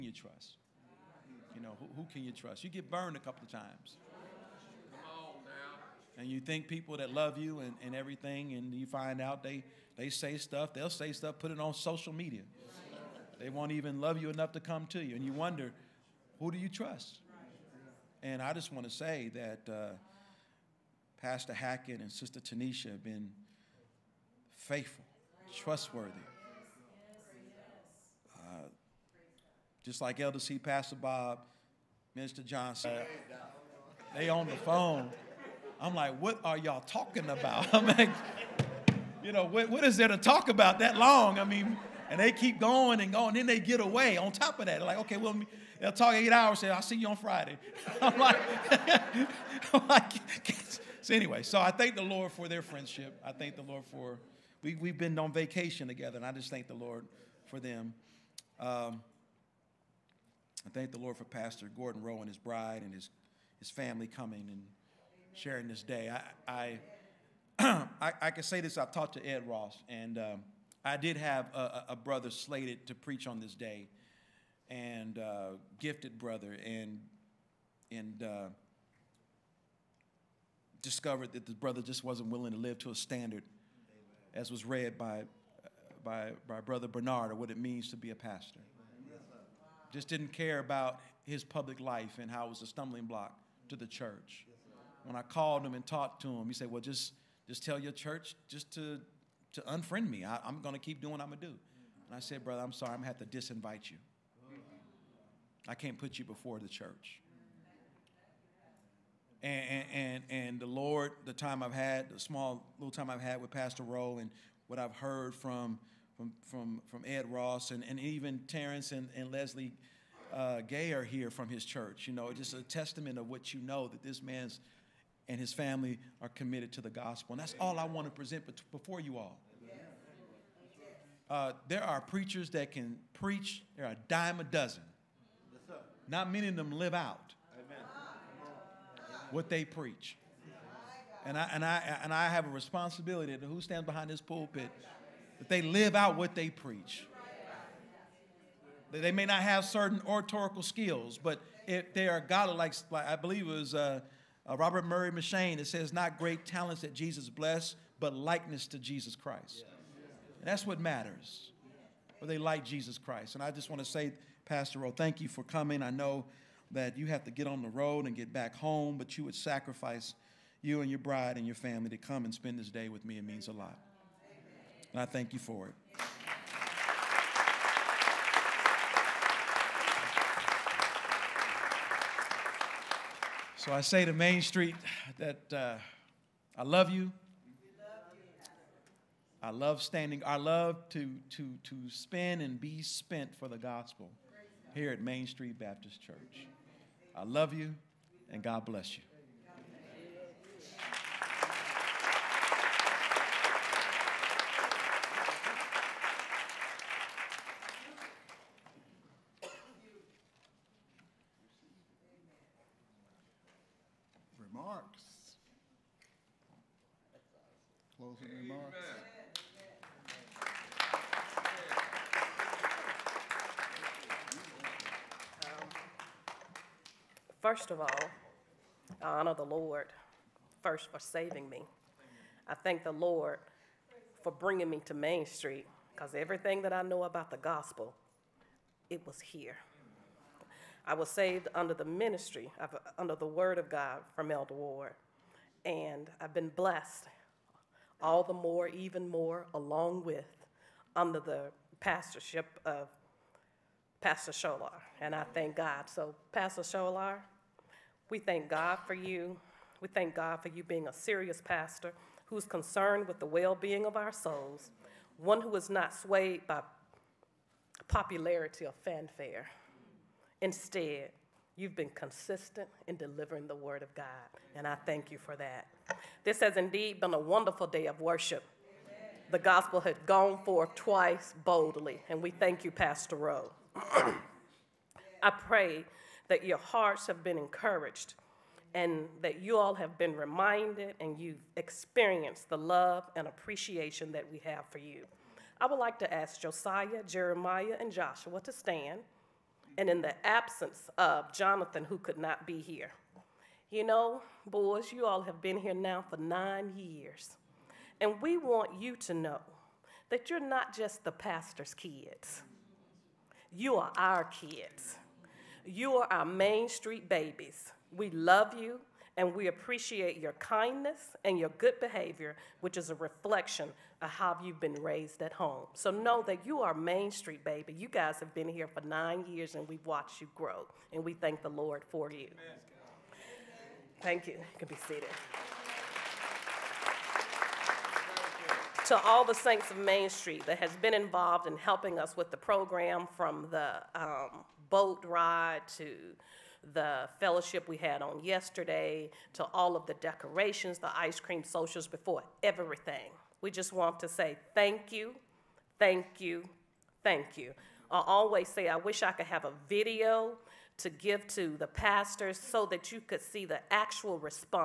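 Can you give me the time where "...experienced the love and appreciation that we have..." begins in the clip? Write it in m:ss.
4:51.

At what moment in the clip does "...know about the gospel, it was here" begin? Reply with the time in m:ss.
3:56.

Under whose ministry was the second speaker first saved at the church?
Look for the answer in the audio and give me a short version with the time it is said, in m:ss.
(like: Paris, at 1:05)
Elder Ward, at 4:04.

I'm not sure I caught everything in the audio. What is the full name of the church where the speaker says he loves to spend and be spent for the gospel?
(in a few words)
Main Street Baptist Church.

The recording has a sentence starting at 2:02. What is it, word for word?
You know, just a testament of what you know that this man's and his family are committed to the gospel.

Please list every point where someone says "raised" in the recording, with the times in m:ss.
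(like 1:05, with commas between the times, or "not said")
5:24.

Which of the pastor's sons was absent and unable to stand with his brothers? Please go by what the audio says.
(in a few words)
Jonathan.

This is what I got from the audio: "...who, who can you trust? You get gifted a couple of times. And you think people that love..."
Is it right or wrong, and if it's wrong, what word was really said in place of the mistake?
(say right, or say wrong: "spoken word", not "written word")
wrong: "burned", not "gifted".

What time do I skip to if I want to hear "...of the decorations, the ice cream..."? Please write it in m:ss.
5:49.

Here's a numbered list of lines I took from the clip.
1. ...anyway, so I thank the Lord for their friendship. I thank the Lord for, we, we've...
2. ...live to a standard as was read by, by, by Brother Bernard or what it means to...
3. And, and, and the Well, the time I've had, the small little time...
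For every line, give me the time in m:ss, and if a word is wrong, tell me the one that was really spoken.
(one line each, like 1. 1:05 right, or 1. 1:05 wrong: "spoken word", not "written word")
1. 0:51 right
2. 1:22 right
3. 1:49 wrong: "Lord", not "Well".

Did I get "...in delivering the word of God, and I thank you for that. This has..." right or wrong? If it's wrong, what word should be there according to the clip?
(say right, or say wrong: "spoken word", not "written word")
right.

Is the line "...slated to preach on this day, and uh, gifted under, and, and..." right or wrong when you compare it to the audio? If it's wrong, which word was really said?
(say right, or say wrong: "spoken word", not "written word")
wrong: "brother", not "under".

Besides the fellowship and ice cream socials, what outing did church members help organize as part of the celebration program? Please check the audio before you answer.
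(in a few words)
boat ride.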